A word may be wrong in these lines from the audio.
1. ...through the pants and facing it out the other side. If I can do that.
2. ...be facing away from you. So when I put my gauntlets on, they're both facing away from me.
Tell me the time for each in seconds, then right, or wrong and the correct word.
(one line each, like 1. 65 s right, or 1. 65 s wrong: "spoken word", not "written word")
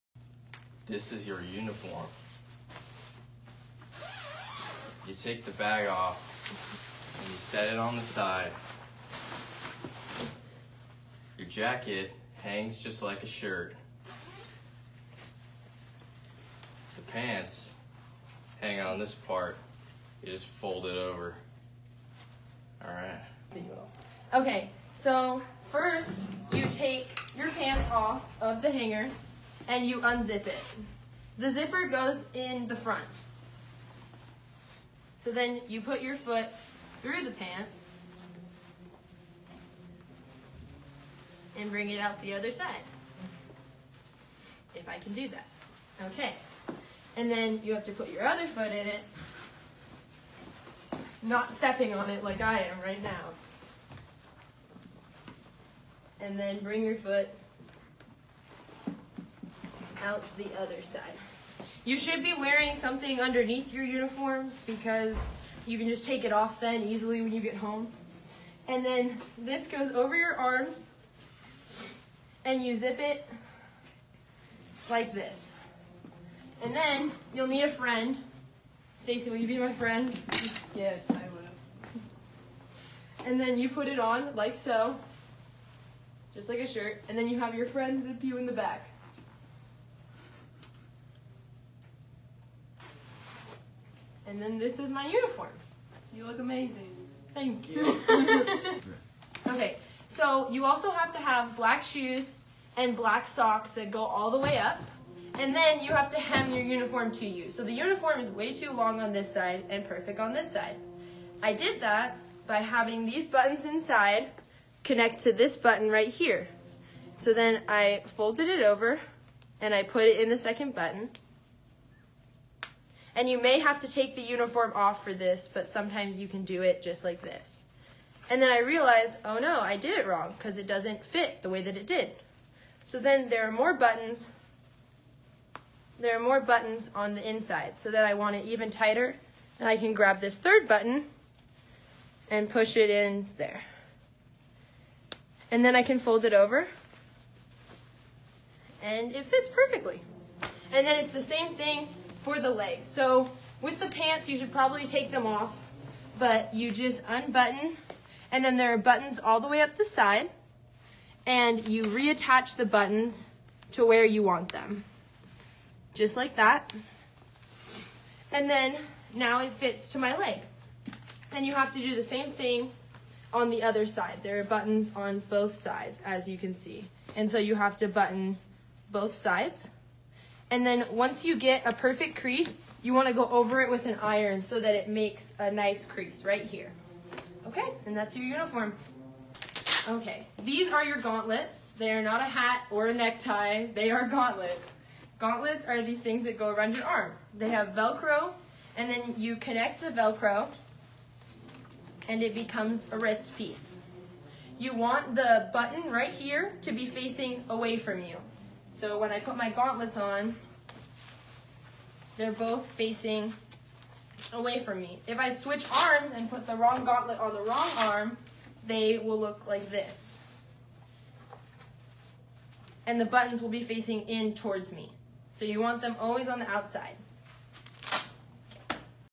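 1. 37 s wrong: "bring", not "facing"
2. 206 s right.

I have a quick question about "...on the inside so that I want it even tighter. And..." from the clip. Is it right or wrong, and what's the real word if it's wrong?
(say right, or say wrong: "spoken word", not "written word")
right.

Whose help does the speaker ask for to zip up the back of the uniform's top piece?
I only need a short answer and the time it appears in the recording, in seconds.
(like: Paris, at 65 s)
Stacy, at 78 s.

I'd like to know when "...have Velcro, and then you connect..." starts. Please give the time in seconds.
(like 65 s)
197 s.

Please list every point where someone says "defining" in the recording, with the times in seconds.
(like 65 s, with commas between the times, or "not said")
not said.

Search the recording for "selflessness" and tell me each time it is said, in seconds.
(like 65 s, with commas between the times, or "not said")
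not said.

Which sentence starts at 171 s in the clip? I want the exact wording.
And you have to do the same thing on the other side.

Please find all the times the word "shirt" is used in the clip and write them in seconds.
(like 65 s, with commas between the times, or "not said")
13 s, 86 s.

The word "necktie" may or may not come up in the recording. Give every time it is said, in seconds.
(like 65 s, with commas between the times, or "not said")
192 s.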